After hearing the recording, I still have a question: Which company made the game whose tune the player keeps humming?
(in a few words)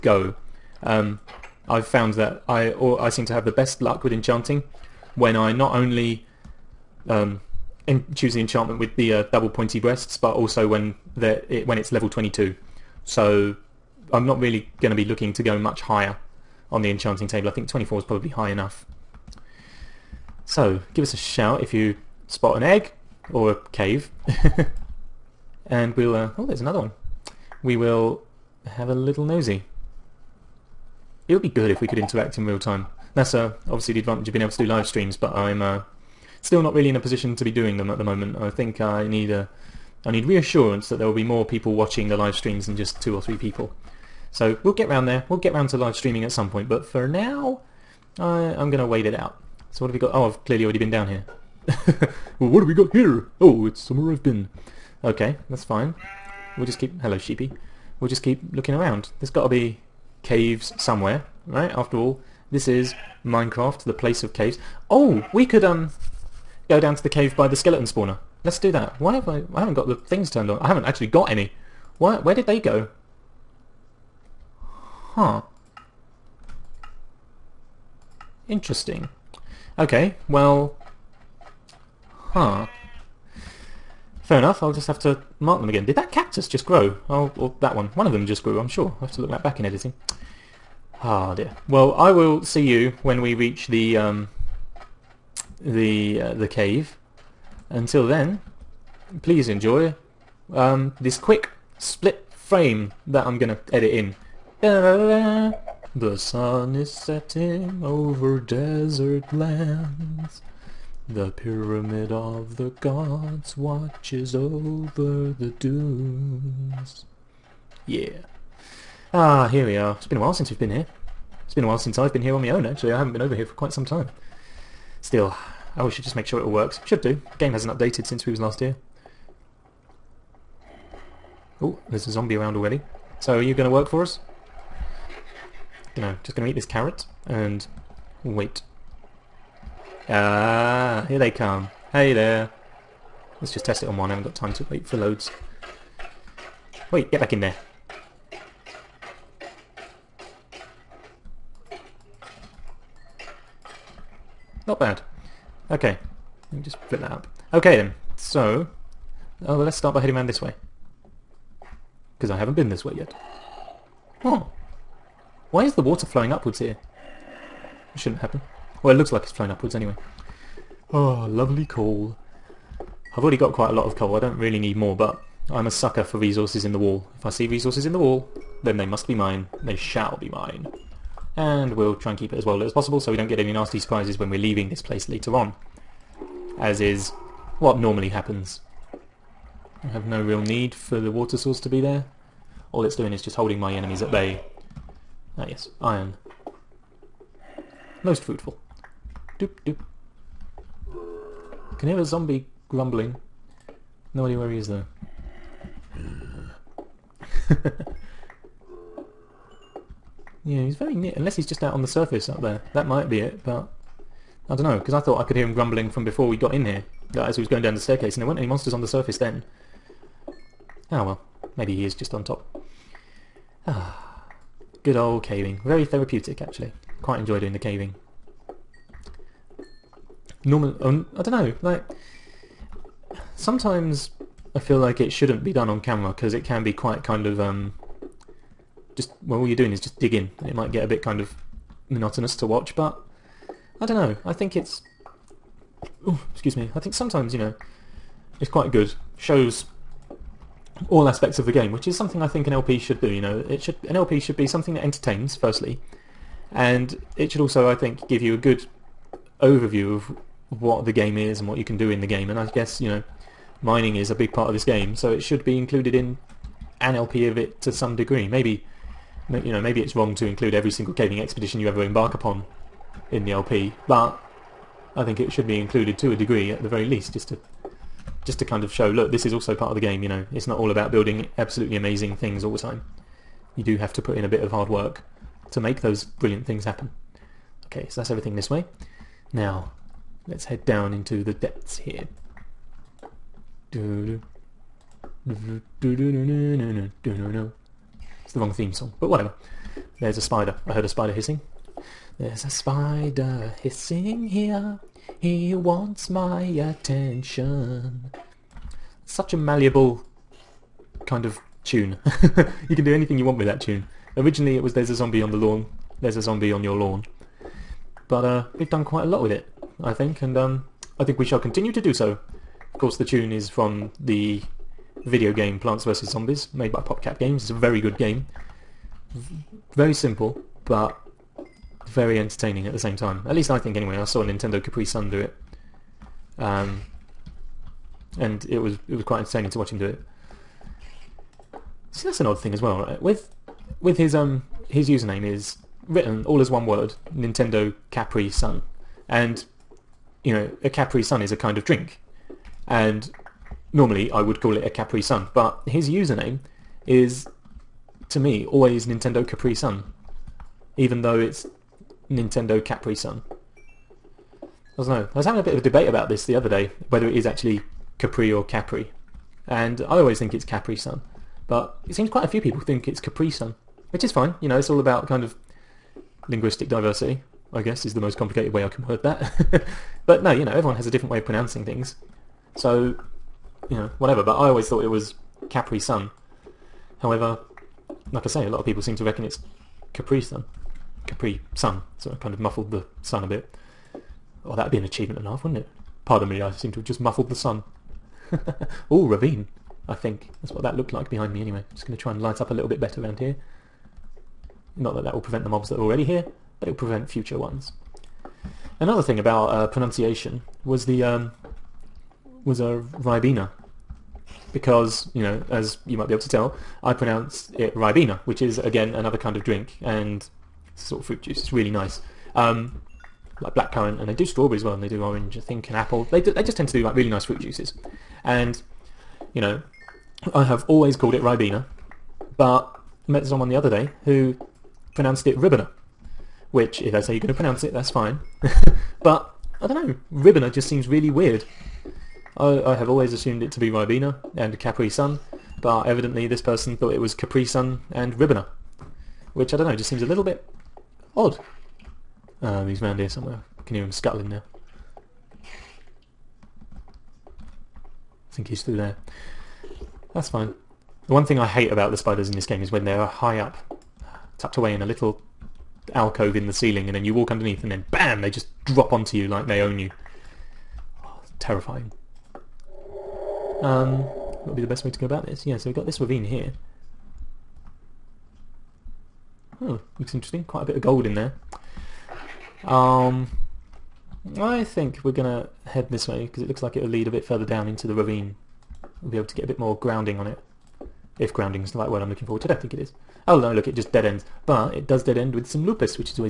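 PopCap Games.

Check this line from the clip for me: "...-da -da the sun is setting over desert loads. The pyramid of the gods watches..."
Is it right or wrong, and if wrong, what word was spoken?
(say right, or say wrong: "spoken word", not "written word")
wrong: "lands", not "loads".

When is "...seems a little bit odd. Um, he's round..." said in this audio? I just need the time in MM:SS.
07:29.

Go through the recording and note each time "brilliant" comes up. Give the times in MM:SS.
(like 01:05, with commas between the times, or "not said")
04:46.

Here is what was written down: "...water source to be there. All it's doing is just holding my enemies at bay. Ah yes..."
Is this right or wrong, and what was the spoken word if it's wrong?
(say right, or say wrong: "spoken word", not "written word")
right.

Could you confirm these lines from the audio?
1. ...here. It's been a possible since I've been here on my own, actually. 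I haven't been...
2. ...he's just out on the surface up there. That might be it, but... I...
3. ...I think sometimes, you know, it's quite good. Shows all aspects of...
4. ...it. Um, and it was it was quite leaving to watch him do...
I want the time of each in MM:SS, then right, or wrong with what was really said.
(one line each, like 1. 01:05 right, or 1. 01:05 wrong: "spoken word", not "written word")
1. 02:00 wrong: "while", not "possible"
2. 03:31 right
3. 04:06 right
4. 05:35 wrong: "entertaining", not "leaving".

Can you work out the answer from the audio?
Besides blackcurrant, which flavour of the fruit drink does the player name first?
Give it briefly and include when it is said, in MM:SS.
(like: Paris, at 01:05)
strawberry, at 07:04.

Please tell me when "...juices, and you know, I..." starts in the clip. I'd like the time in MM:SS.
07:07.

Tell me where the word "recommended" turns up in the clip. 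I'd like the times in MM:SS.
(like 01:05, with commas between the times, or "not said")
not said.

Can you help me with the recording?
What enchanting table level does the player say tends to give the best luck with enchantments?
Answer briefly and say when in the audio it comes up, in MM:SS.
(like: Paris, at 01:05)
22, at 00:11.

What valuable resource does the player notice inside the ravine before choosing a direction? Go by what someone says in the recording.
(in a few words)
gold.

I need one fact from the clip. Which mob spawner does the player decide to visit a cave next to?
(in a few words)
skeleton spawner.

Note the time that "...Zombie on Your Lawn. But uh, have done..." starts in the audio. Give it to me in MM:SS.
05:16.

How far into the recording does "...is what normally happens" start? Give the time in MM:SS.
03:06.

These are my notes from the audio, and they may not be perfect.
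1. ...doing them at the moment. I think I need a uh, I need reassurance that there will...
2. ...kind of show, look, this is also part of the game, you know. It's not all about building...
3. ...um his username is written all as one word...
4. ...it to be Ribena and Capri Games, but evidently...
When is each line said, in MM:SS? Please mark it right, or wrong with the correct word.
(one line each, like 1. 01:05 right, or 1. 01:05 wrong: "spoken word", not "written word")
1. 00:37 right
2. 04:38 right
3. 05:44 right
4. 07:23 wrong: "Sun", not "Games".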